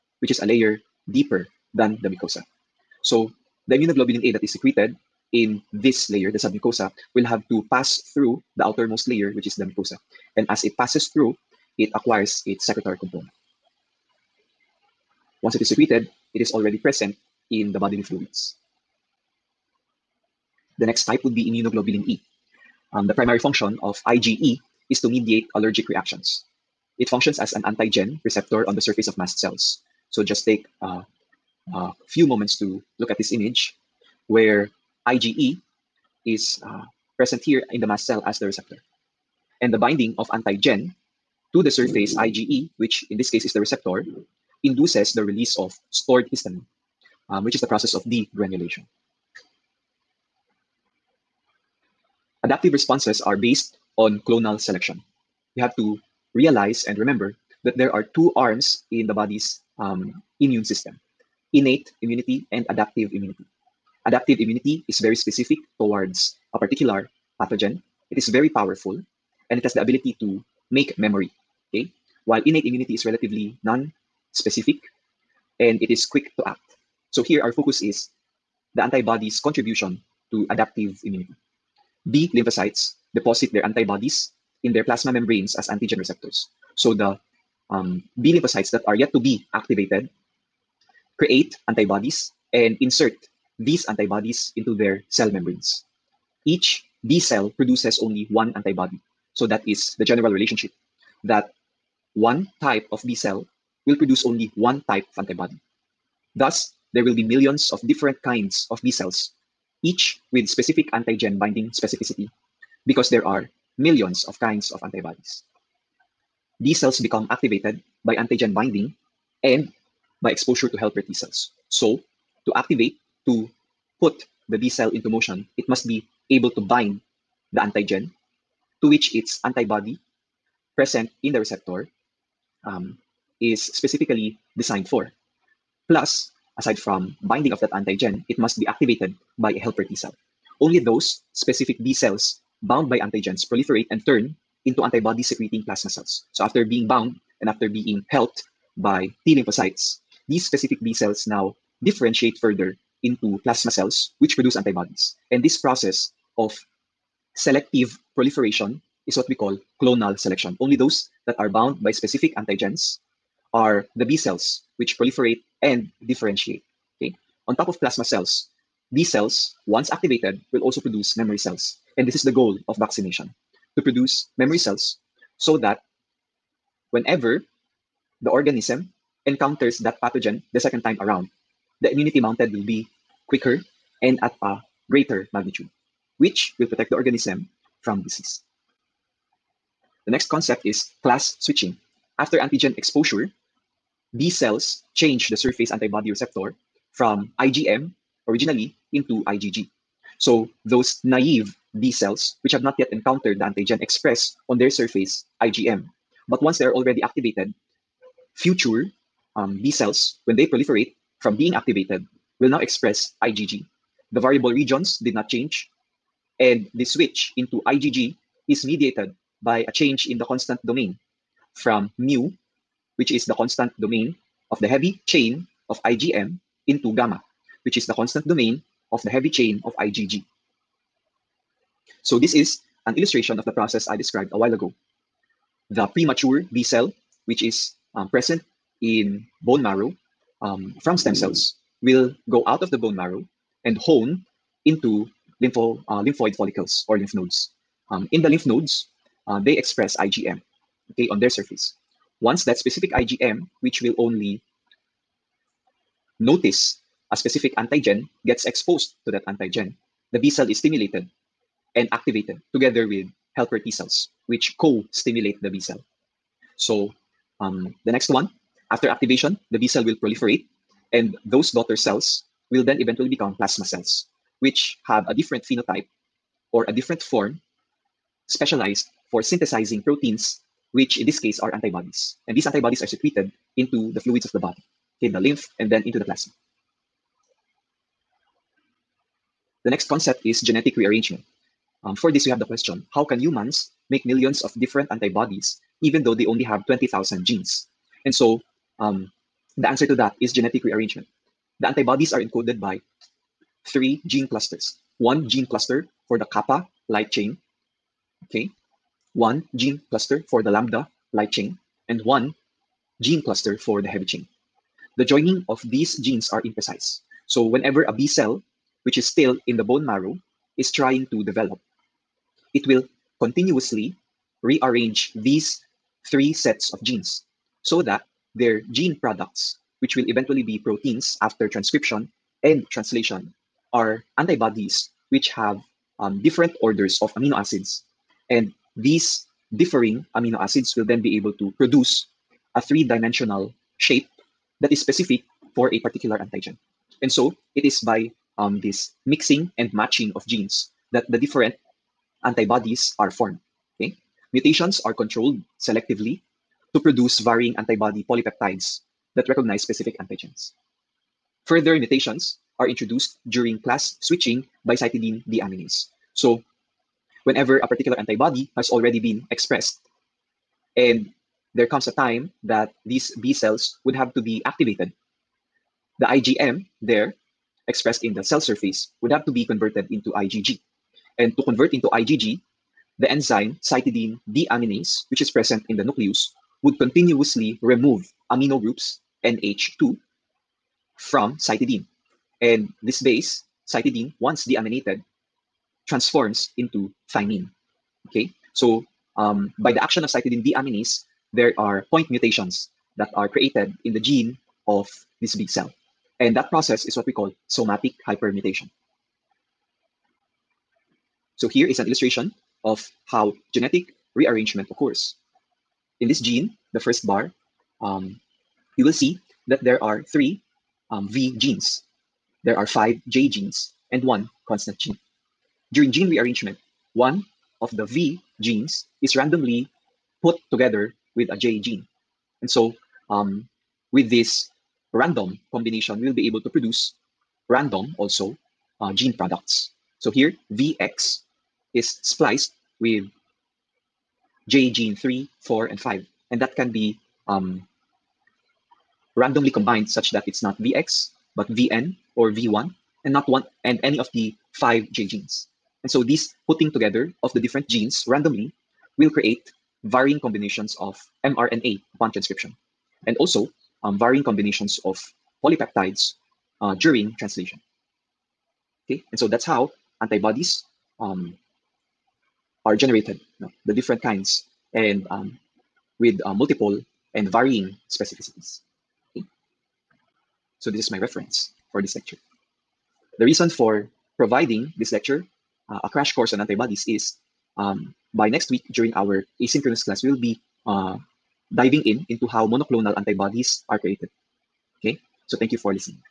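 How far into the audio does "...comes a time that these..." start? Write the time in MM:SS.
06:11.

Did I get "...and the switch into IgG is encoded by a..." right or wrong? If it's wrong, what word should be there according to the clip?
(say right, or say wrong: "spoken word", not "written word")
wrong: "mediated", not "encoded".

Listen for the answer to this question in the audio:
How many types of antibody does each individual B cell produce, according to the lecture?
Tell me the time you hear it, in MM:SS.
01:38.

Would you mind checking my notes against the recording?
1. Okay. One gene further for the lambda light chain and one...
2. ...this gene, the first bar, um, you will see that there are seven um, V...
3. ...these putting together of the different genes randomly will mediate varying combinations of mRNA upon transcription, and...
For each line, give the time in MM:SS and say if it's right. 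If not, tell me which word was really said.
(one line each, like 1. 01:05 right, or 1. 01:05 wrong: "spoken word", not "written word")
1. 05:08 wrong: "cluster", not "further"
2. 06:56 wrong: "three", not "seven"
3. 07:36 wrong: "create", not "mediate".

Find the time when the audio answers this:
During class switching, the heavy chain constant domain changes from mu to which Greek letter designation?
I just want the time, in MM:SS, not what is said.
03:46.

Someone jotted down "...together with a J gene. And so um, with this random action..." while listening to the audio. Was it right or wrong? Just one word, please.
wrong.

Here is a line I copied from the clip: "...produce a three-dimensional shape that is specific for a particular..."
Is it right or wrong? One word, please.
right.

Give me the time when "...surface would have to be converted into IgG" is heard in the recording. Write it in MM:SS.
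06:18.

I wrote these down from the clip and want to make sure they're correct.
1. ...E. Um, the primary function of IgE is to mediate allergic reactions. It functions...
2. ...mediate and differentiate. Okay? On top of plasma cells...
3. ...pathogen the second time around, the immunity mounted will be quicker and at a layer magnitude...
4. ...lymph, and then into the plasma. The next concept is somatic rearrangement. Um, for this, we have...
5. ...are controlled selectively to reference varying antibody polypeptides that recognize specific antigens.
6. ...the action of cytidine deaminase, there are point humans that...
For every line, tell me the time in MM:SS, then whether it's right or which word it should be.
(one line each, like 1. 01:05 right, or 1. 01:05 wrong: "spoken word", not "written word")
1. 00:22 right
2. 02:44 wrong: "proliferate", not "mediate"
3. 03:00 wrong: "greater", not "layer"
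4. 04:45 wrong: "genetic", not "somatic"
5. 05:54 wrong: "produce", not "reference"
6. 06:39 wrong: "mutations", not "humans".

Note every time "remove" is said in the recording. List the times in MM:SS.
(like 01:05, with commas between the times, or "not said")
06:27.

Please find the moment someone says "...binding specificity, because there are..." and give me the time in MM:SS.
01:51.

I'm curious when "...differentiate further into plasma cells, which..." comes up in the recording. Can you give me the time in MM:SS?
02:31.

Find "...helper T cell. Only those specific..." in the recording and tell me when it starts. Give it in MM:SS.
02:19.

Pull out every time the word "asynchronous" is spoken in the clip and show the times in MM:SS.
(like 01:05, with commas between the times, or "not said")
08:09.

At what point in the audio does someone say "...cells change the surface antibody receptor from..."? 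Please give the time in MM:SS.
03:14.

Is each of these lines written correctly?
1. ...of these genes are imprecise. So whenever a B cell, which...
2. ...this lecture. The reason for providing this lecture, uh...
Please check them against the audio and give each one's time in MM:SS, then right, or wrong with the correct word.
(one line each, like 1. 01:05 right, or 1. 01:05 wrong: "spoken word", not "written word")
1. 05:15 right
2. 08:01 right.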